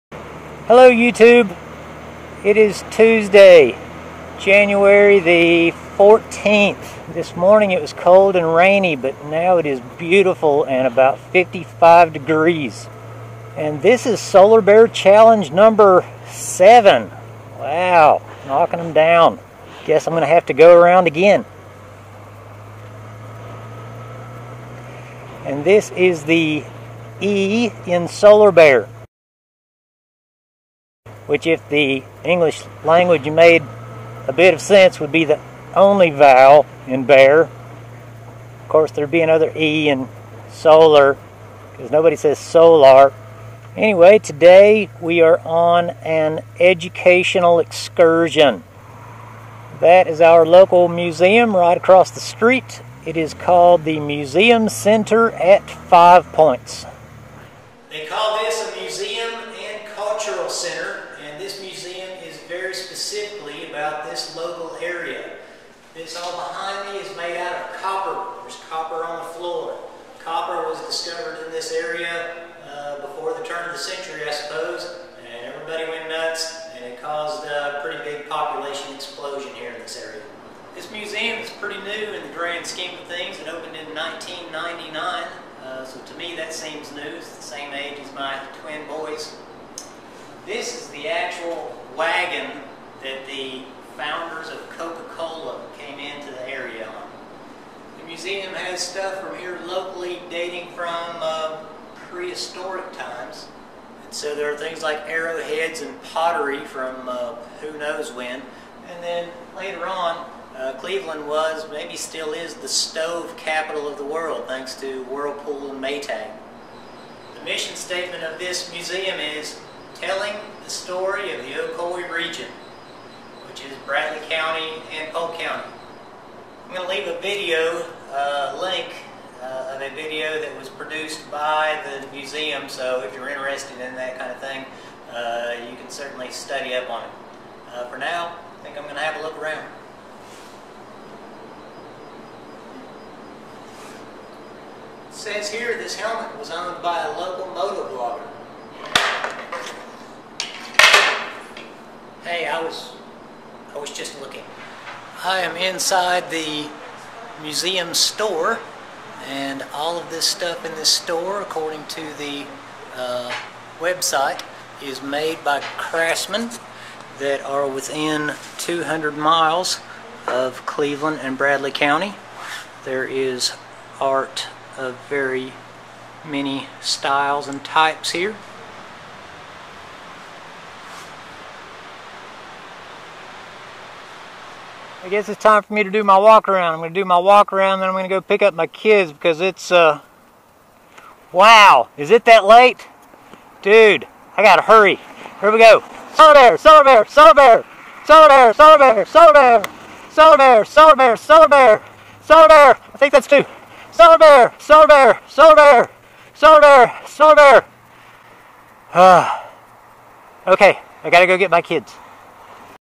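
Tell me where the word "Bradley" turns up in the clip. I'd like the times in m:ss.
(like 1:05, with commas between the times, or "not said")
2:03, 2:51.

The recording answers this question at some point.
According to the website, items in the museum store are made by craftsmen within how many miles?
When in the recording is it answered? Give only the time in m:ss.
2:48.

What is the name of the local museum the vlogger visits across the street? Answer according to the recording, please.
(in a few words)
Museum Center at Five Points.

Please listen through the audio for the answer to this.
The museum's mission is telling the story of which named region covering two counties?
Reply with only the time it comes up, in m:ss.
2:01.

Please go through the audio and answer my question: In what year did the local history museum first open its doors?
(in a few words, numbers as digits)
1999.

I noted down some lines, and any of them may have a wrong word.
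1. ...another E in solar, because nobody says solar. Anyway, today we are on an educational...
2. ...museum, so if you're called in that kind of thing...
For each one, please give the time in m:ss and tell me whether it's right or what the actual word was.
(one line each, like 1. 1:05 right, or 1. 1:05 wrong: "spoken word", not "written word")
1. 0:39 right
2. 2:12 wrong: "interested", not "called".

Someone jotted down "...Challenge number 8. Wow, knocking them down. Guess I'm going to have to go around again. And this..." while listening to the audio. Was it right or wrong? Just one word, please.
wrong.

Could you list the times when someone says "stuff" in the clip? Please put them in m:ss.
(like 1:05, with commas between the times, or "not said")
1:38, 2:40.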